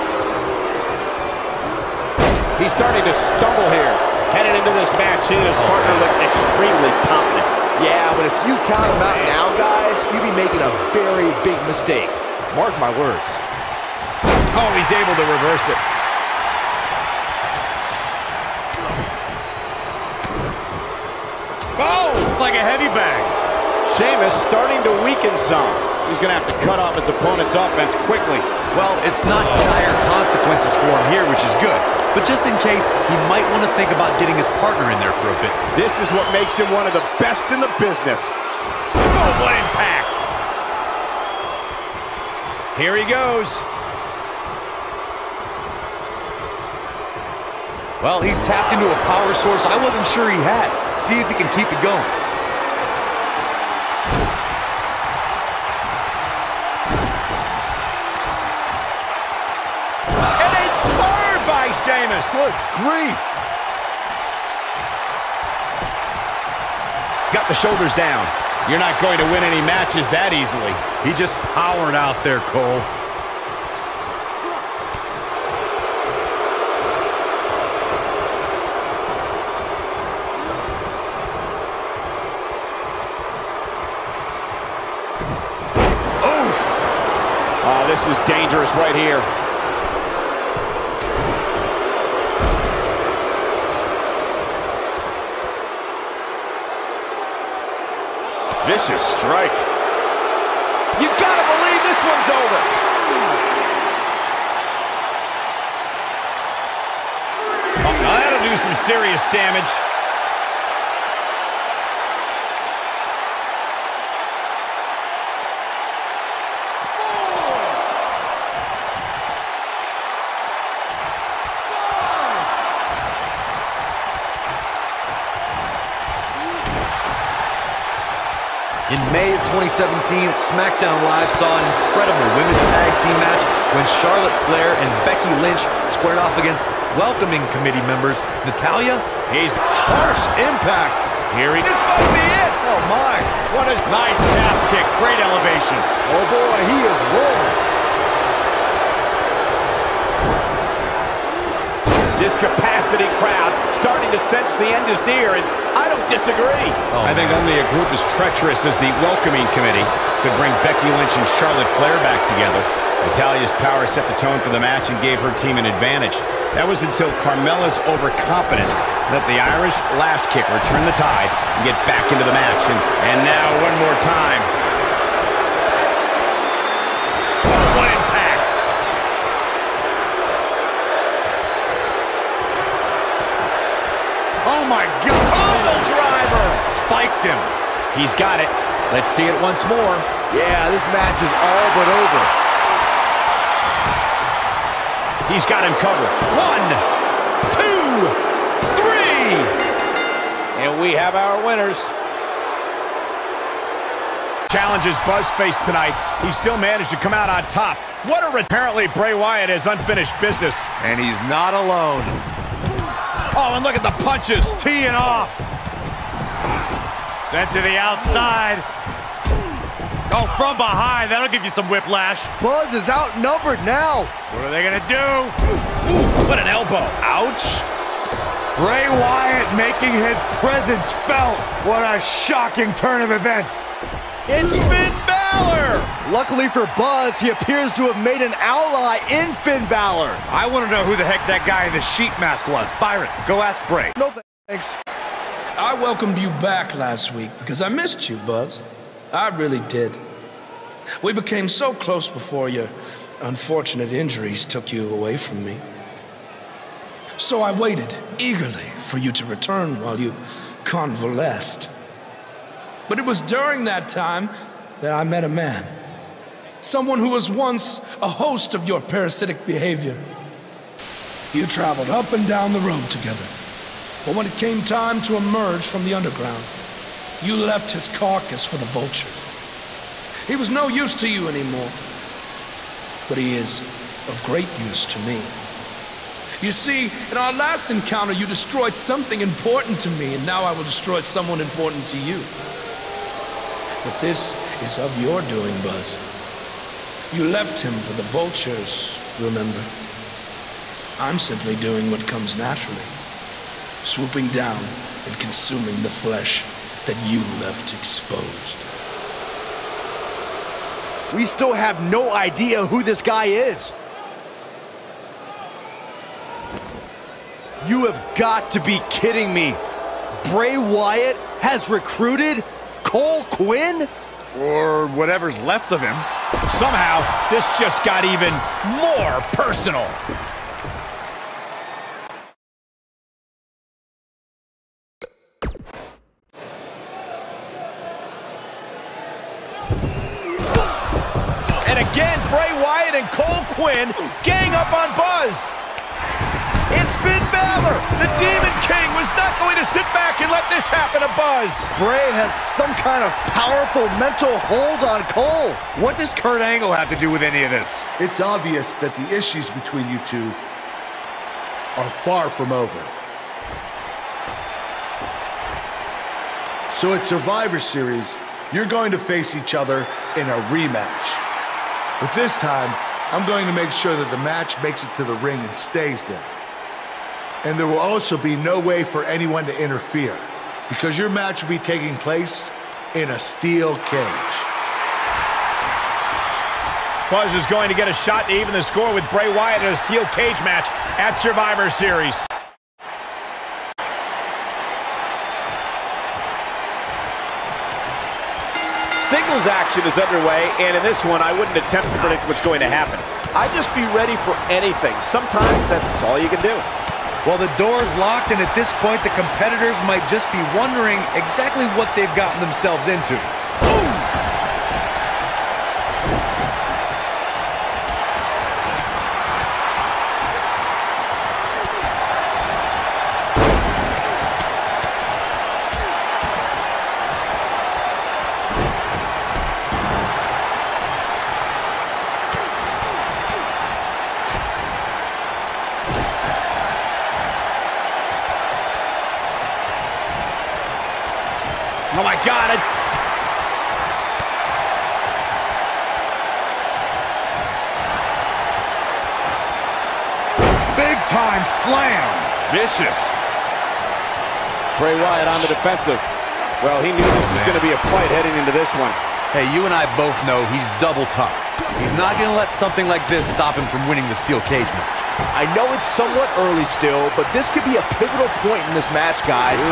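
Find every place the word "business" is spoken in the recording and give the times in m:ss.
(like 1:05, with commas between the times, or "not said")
0:37, 3:30.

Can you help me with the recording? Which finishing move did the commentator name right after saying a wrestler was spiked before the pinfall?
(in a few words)
Pommel driver.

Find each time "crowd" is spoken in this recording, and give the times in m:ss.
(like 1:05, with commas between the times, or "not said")
2:33.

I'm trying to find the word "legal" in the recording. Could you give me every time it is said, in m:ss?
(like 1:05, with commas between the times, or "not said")
not said.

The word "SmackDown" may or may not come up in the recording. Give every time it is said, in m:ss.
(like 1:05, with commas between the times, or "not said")
2:10.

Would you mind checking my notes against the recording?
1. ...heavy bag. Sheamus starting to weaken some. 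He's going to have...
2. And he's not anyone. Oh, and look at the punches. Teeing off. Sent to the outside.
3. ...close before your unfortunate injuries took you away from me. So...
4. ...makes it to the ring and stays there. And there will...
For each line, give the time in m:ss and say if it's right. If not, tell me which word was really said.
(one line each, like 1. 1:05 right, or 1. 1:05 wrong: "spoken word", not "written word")
1. 0:22 right
2. 3:30 wrong: "alone", not "anyone"
3. 4:11 right
4. 6:14 right.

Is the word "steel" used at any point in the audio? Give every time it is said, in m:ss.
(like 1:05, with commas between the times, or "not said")
6:23, 6:29, 7:44.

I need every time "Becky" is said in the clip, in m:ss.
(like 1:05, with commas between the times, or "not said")
2:15, 2:40.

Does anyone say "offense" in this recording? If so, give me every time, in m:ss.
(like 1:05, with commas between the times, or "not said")
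0:27.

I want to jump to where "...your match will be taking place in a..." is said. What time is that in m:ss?
6:20.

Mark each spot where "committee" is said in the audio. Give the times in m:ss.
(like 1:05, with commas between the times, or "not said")
2:17, 2:39.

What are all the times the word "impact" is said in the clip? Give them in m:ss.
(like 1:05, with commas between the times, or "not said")
0:39, 2:20.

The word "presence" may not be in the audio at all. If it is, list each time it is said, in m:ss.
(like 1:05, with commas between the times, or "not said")
3:50.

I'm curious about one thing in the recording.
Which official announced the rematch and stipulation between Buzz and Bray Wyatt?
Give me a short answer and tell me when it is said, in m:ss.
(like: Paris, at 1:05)
Kurt Angle, at 5:56.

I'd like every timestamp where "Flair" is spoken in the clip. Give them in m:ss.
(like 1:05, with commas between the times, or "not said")
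2:14, 2:41.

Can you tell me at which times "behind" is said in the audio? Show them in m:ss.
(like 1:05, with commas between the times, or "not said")
3:40.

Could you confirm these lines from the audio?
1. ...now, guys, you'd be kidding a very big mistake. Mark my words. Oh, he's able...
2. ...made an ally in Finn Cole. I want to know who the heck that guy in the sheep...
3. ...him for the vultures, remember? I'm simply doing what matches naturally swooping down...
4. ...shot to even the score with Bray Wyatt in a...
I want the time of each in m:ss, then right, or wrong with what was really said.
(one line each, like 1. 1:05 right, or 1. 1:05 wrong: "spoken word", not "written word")
1. 0:09 wrong: "making", not "kidding"
2. 3:58 wrong: "Balor", not "Cole"
3. 4:57 wrong: "comes", not "matches"
4. 6:27 right.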